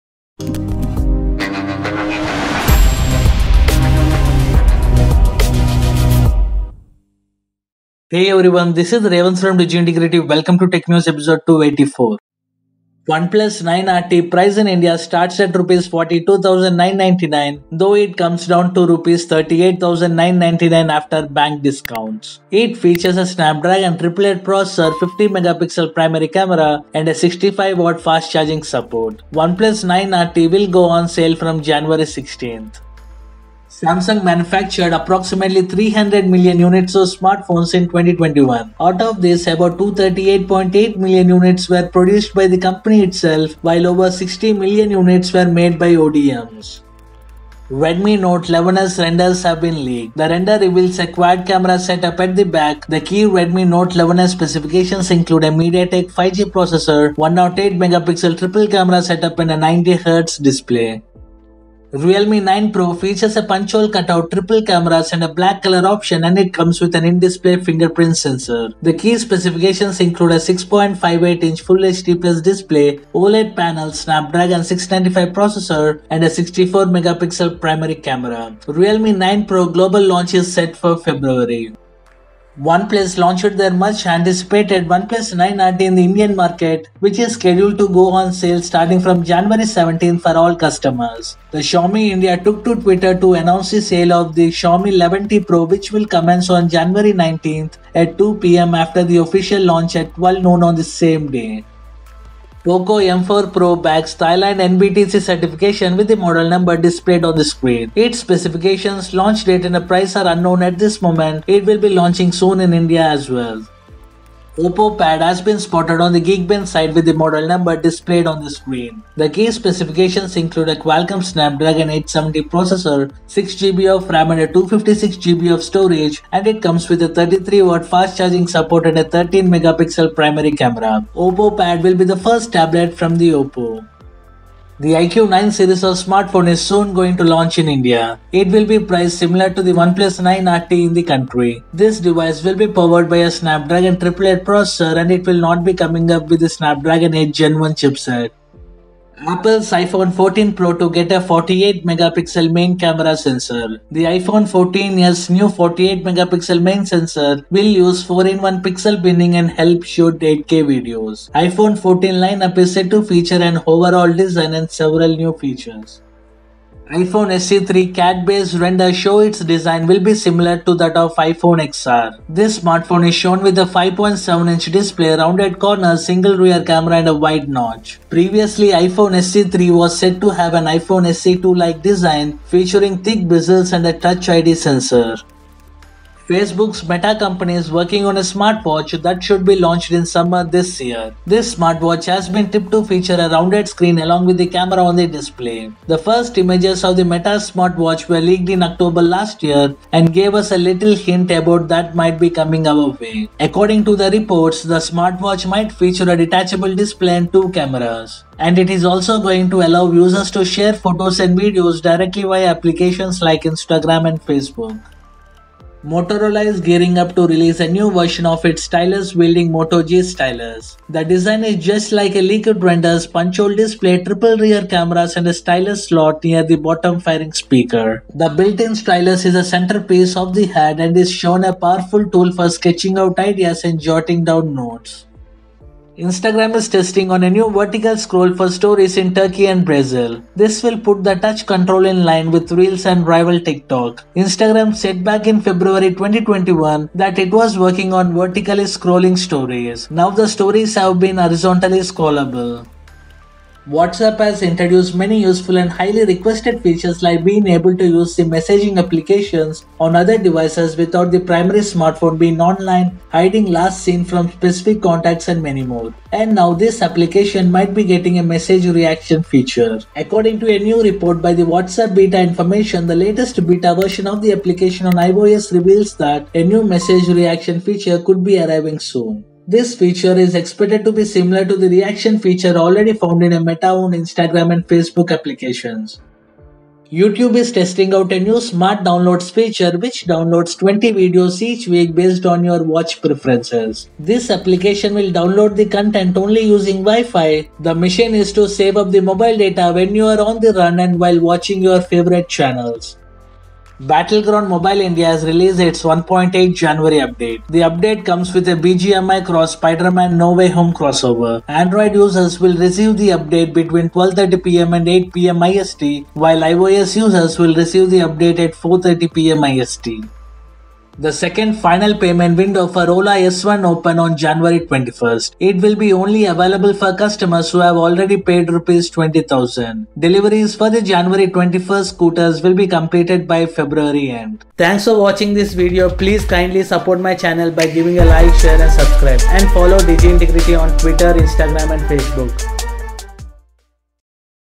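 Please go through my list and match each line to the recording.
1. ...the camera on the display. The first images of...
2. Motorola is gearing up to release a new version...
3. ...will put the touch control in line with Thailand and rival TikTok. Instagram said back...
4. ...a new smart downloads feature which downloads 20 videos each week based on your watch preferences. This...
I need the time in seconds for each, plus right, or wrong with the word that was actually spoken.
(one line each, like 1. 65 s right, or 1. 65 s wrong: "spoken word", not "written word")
1. 194 s right
2. 215 s right
3. 240 s wrong: "Reels", not "Thailand"
4. 288 s right.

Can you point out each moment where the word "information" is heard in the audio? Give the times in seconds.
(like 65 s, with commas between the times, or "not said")
272 s.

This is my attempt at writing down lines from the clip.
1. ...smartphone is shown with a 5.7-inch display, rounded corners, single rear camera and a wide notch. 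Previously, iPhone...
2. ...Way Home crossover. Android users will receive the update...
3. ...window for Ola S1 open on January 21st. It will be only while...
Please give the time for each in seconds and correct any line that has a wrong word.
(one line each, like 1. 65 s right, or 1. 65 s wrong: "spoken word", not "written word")
1. 172 s right
2. 310 s right
3. 322 s wrong: "available", not "while".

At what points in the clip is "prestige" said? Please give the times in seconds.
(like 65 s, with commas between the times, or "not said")
not said.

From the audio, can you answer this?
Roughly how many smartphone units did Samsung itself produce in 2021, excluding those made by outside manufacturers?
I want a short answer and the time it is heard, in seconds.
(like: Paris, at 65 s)
238.8 million, at 39 s.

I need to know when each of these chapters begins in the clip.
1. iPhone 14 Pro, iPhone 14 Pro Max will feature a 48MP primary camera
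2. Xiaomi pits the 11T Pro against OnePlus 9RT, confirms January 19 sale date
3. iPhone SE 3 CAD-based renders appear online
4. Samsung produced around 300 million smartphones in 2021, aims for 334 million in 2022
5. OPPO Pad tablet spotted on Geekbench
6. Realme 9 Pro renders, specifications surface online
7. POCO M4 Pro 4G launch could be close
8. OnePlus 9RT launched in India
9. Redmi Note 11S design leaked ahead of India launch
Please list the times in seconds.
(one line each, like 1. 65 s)
1. 149 s
2. 82 s
3. 166 s
4. 33 s
5. 114 s
6. 61 s
7. 102 s
8. 13 s
9. 47 s.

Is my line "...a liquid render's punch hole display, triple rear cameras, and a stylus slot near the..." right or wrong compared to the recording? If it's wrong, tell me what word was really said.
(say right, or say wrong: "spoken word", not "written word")
right.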